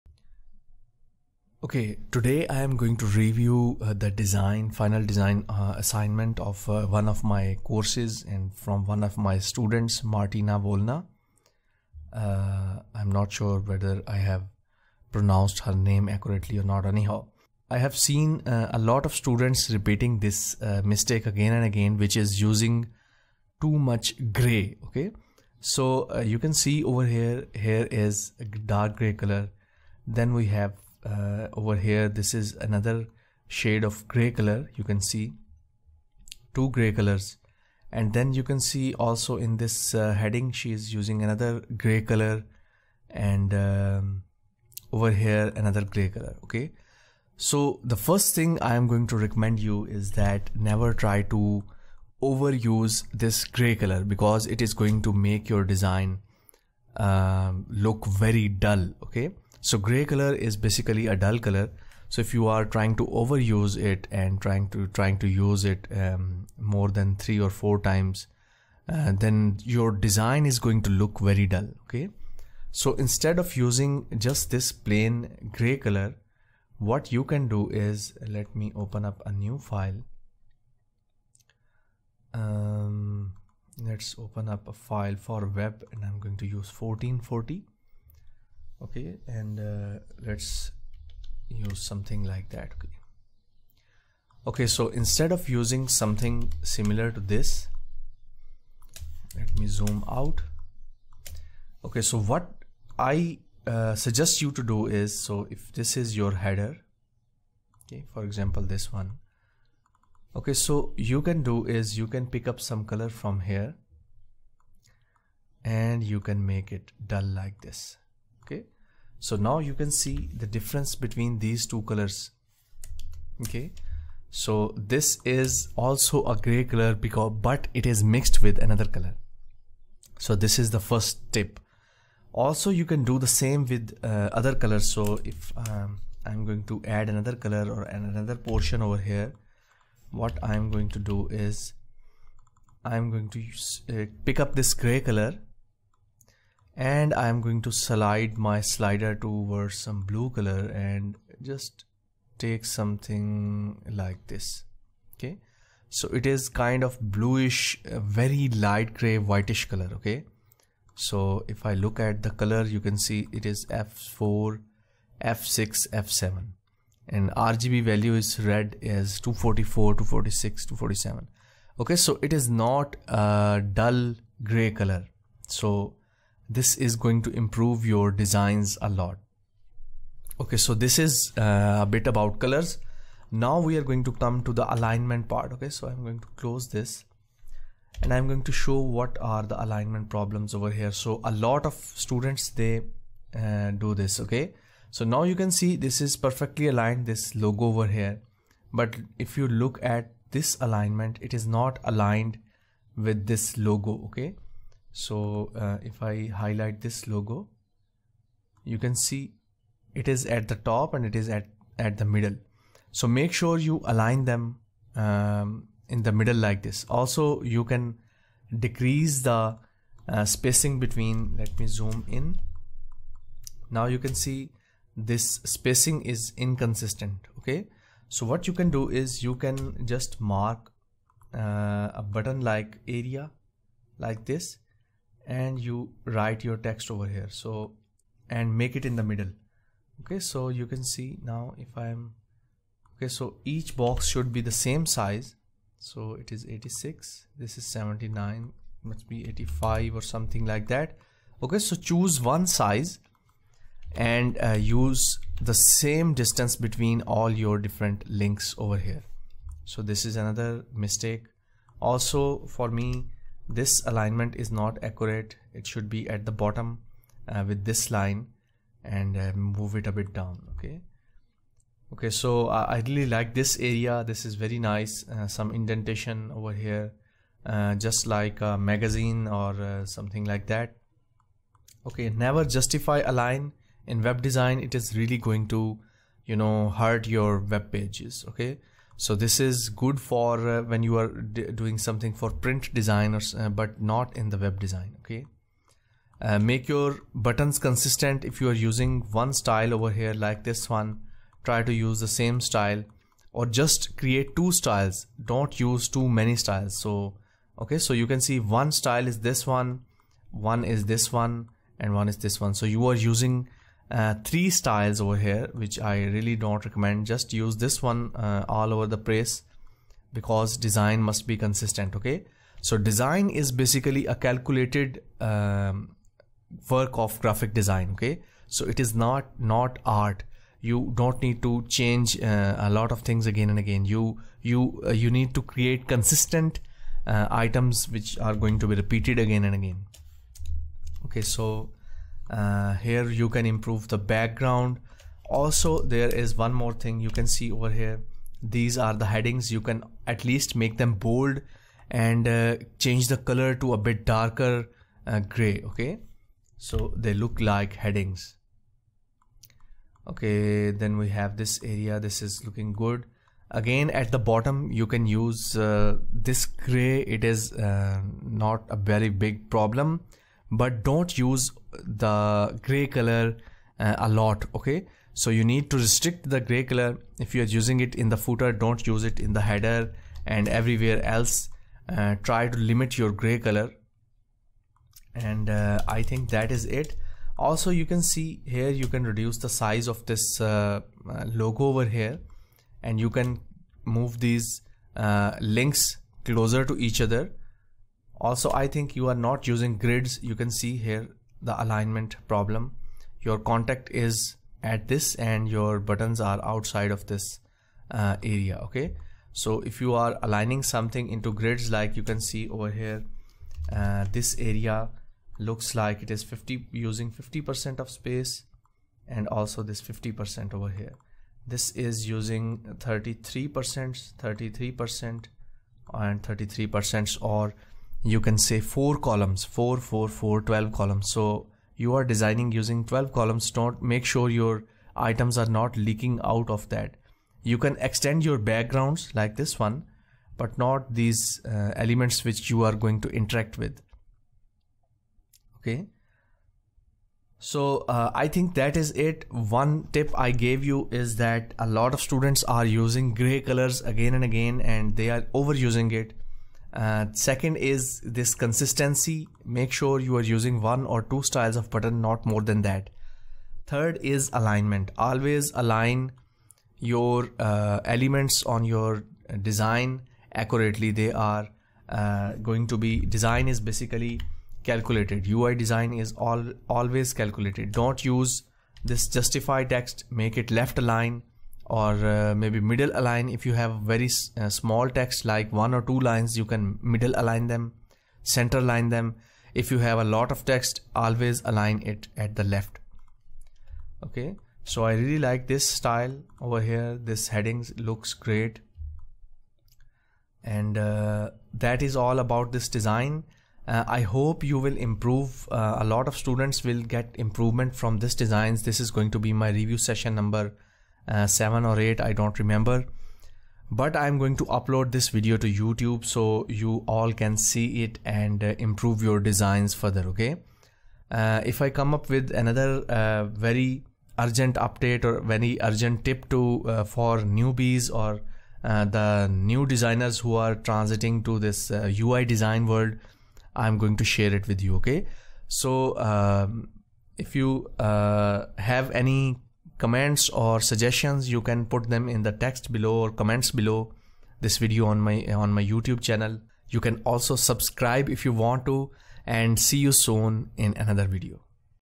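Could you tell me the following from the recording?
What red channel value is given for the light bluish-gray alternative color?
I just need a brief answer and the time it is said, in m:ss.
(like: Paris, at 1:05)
244, at 2:49.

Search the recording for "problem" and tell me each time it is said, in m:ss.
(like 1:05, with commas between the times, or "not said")
3:10, 6:09, 6:42.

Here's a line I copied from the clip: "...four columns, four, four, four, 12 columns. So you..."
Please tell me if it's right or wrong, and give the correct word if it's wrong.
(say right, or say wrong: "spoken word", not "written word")
right.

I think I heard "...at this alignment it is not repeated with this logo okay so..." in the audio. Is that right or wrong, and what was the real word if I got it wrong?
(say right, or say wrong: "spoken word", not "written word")
wrong: "aligned", not "repeated".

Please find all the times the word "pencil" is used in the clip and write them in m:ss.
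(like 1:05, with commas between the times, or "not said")
not said.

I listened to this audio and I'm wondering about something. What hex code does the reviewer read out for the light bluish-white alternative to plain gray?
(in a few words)
f4 f6 f7.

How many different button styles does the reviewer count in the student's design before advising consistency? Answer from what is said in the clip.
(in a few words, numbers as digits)
3.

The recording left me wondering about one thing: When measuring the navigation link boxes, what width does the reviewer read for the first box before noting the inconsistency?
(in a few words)
86.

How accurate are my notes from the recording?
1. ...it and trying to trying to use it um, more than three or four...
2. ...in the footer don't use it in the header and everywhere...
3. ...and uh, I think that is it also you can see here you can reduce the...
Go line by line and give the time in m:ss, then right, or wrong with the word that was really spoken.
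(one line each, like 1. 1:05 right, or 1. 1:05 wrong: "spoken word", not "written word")
1. 1:03 right
2. 6:17 right
3. 6:25 right.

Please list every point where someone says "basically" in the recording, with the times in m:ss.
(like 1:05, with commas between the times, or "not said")
1:00, 5:23, 7:53.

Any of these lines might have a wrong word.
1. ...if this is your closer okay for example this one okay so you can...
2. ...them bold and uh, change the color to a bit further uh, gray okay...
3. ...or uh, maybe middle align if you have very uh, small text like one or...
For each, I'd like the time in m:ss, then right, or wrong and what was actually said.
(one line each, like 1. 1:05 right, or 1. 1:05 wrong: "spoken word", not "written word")
1. 1:45 wrong: "header", not "closer"
2. 5:50 wrong: "darker", not "further"
3. 8:01 right.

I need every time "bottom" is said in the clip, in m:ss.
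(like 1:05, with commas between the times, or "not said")
4:26, 6:04.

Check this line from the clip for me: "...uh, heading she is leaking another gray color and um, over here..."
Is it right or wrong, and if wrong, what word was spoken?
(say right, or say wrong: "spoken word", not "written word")
wrong: "using", not "leaking".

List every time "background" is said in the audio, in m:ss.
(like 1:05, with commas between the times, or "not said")
5:43, 7:18.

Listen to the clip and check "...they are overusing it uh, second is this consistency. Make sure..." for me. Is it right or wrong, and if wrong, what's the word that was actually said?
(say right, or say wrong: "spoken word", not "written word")
right.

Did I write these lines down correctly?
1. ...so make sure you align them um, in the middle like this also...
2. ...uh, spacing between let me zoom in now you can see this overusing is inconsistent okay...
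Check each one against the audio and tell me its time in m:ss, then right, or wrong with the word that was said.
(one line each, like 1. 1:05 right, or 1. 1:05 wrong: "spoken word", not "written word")
1. 3:32 right
2. 3:40 wrong: "spacing", not "overusing".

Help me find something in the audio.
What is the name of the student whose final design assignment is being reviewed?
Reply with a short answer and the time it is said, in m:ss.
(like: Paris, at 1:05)
Martina Volna, at 0:10.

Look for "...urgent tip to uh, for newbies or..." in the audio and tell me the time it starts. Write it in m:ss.
8:45.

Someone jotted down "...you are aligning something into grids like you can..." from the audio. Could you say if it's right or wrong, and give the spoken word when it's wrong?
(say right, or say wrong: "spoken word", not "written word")
right.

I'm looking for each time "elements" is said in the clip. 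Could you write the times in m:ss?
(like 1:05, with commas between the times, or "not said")
7:21, 7:47.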